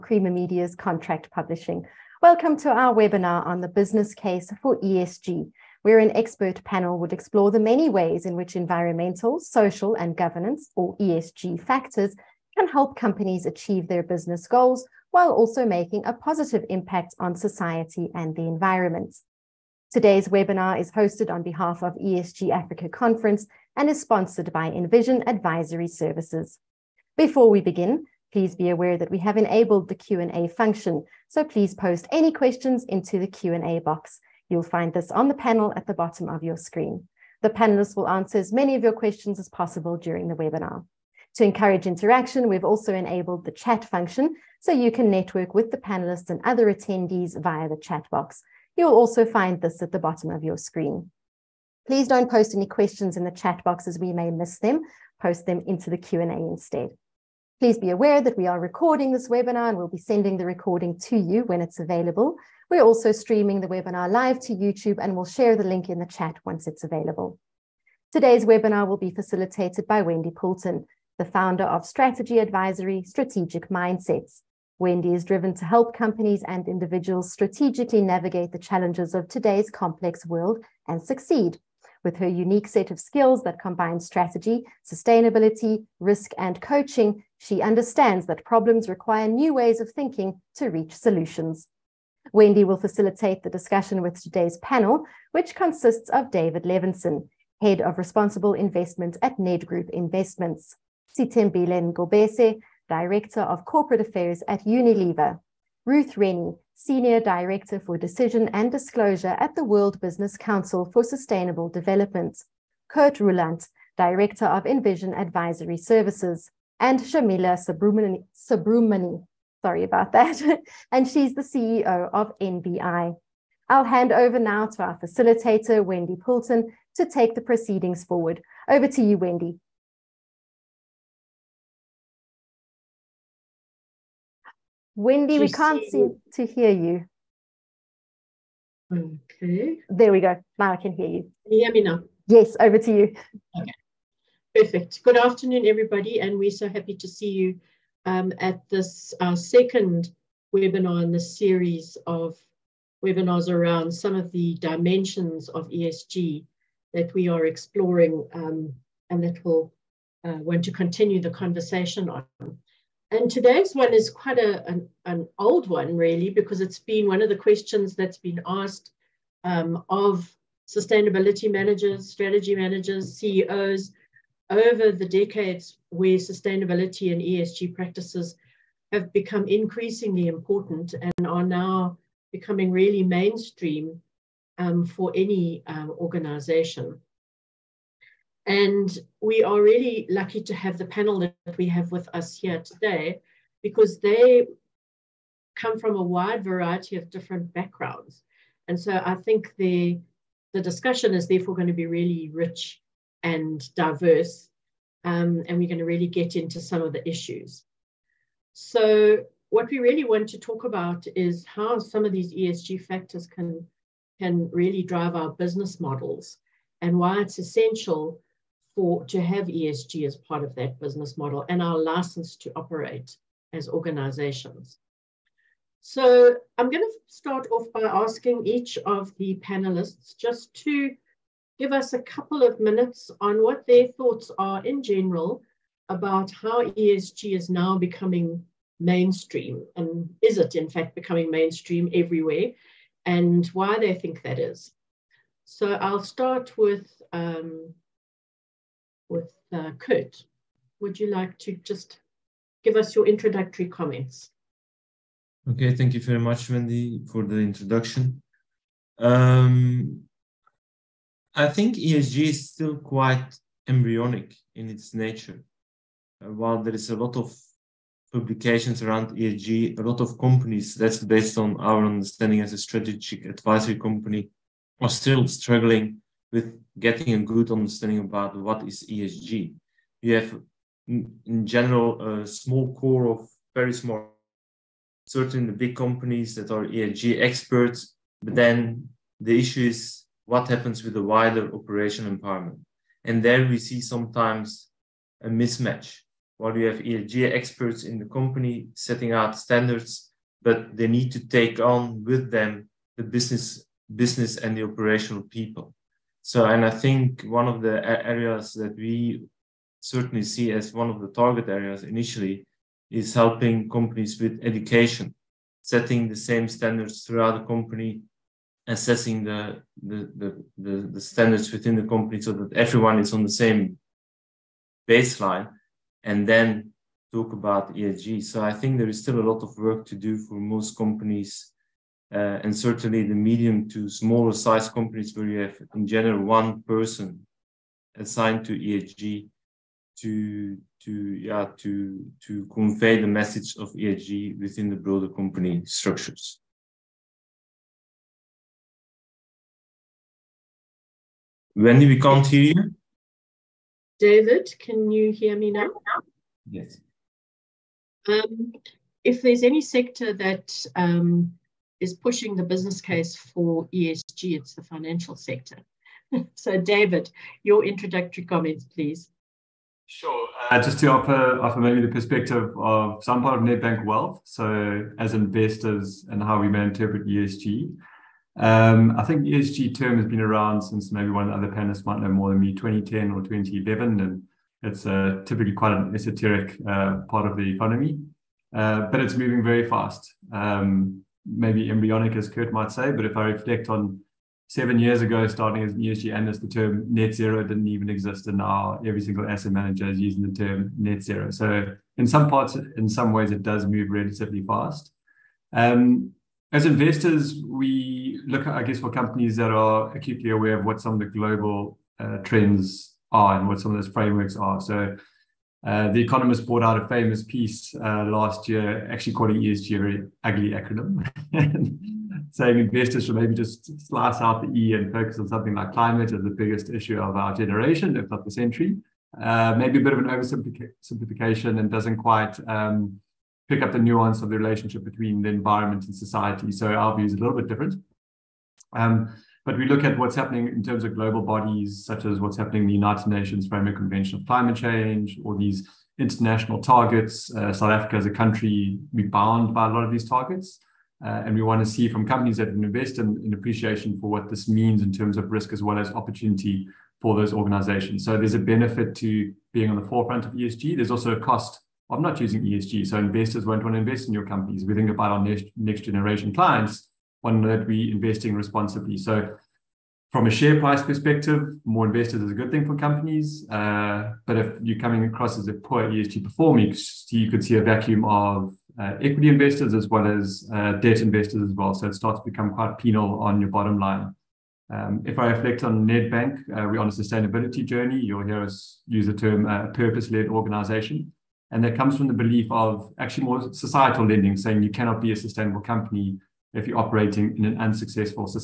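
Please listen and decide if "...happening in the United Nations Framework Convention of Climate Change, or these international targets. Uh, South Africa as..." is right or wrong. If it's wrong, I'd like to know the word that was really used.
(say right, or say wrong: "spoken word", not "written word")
right.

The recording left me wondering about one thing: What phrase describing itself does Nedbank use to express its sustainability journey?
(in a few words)
purpose-led organization.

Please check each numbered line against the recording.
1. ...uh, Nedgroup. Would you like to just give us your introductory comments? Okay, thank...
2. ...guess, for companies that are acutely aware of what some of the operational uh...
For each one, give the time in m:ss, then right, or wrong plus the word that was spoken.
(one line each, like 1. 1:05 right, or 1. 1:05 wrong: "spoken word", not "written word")
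1. 4:09 wrong: "Kurt", not "Nedgroup"
2. 6:48 wrong: "global", not "operational".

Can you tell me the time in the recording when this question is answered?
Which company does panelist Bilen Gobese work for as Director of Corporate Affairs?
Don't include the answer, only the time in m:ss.
1:44.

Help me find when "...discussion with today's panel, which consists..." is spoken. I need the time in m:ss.
1:33.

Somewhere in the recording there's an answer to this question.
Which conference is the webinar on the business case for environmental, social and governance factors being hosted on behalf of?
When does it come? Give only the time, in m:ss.
0:21.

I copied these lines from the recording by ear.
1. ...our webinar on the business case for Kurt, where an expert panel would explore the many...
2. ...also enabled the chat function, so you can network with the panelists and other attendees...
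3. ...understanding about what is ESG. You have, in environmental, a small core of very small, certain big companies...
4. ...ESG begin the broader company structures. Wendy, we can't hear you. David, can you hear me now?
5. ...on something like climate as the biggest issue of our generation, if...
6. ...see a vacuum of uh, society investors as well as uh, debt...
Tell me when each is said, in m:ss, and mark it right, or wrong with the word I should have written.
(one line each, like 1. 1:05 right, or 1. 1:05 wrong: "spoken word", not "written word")
1. 0:02 wrong: "ESG", not "Kurt"
2. 0:42 right
3. 4:37 wrong: "general", not "environmental"
4. 5:43 wrong: "within", not "begin"
5. 7:05 right
6. 7:57 wrong: "equity", not "society".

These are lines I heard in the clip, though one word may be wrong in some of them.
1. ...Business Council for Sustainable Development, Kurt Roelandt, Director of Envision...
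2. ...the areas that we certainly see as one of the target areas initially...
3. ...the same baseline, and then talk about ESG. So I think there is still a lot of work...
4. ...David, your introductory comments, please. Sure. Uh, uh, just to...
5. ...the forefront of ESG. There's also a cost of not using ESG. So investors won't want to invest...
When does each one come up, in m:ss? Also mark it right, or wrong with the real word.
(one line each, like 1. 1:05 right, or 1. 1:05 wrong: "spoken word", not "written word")
1. 1:50 right
2. 5:07 right
3. 5:23 right
4. 6:06 right
5. 7:39 right.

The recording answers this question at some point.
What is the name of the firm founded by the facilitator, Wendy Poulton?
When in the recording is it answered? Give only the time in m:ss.
1:13.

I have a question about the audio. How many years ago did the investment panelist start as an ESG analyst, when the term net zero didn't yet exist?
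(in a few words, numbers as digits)
7.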